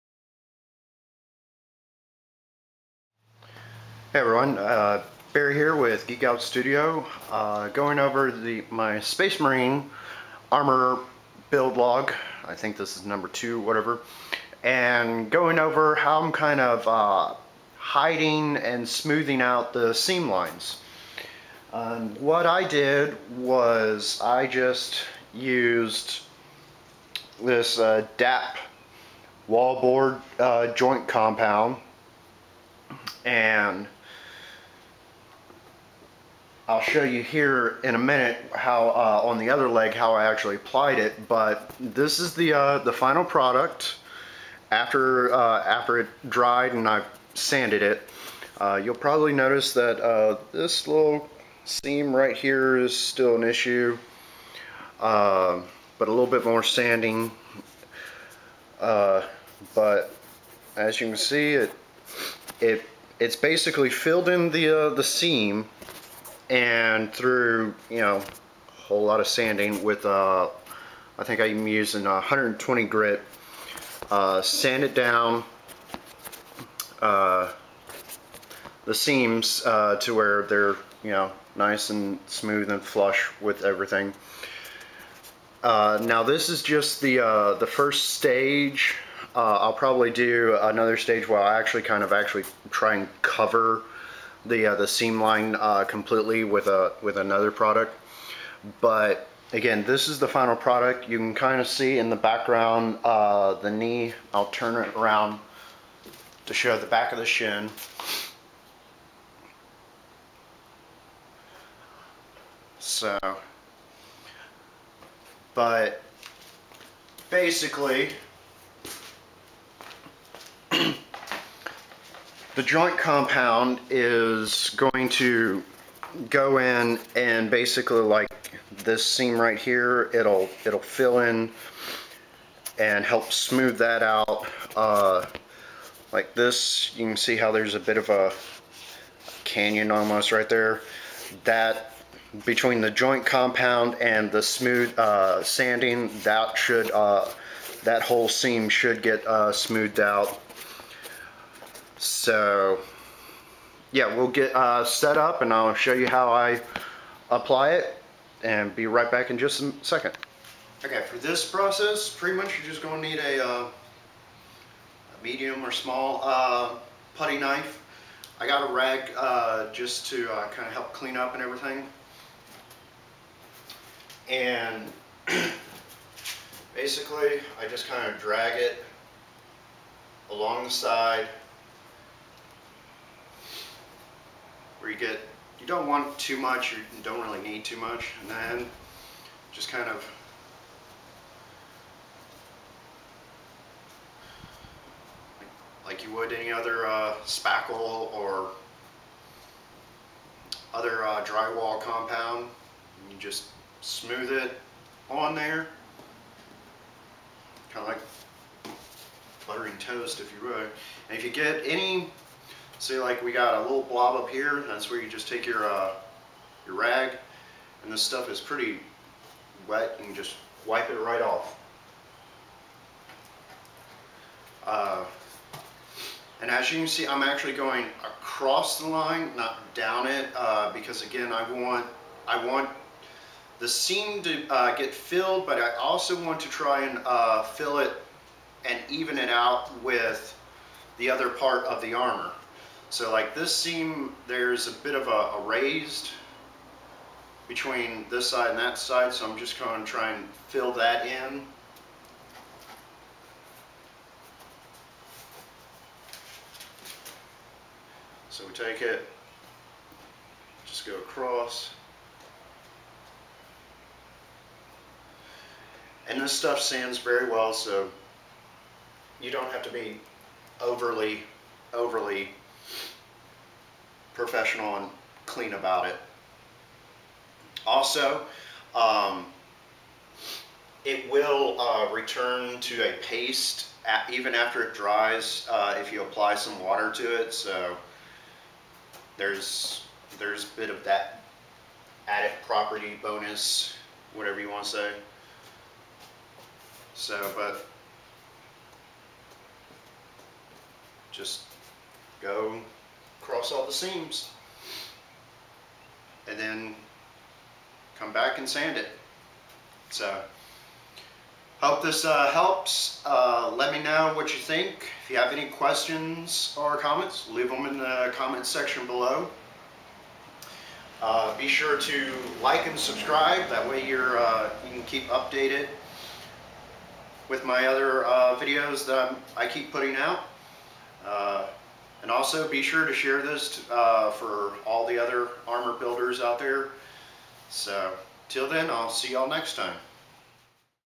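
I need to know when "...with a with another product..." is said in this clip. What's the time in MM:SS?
01:36.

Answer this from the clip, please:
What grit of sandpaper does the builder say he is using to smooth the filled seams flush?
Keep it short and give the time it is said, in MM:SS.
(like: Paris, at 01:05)
120 grit, at 01:12.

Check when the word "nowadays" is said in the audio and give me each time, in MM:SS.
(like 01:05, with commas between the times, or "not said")
not said.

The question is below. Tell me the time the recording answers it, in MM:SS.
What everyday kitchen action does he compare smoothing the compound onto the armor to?
03:29.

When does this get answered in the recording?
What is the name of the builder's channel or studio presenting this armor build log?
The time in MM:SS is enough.
00:06.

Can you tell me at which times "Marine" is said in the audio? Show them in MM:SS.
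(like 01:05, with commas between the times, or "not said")
00:09.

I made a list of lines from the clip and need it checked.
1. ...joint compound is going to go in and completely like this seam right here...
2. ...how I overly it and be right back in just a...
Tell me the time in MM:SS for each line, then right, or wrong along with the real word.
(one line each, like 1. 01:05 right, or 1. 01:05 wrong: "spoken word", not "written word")
1. 02:02 wrong: "basically", not "completely"
2. 02:36 wrong: "apply", not "overly".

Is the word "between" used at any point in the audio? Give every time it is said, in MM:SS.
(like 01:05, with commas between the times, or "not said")
02:22, 04:07.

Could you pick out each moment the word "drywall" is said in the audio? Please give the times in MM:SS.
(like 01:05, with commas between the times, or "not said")
03:21.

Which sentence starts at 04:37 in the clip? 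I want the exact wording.
Also, um, it will uh, return to a paste at, even after it dries uh, if you apply some water to it.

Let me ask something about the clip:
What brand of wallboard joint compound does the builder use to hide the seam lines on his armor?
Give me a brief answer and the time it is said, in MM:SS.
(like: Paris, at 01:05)
DAP, at 00:28.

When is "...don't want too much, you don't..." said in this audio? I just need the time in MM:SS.
03:05.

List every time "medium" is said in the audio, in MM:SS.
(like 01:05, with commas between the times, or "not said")
02:45.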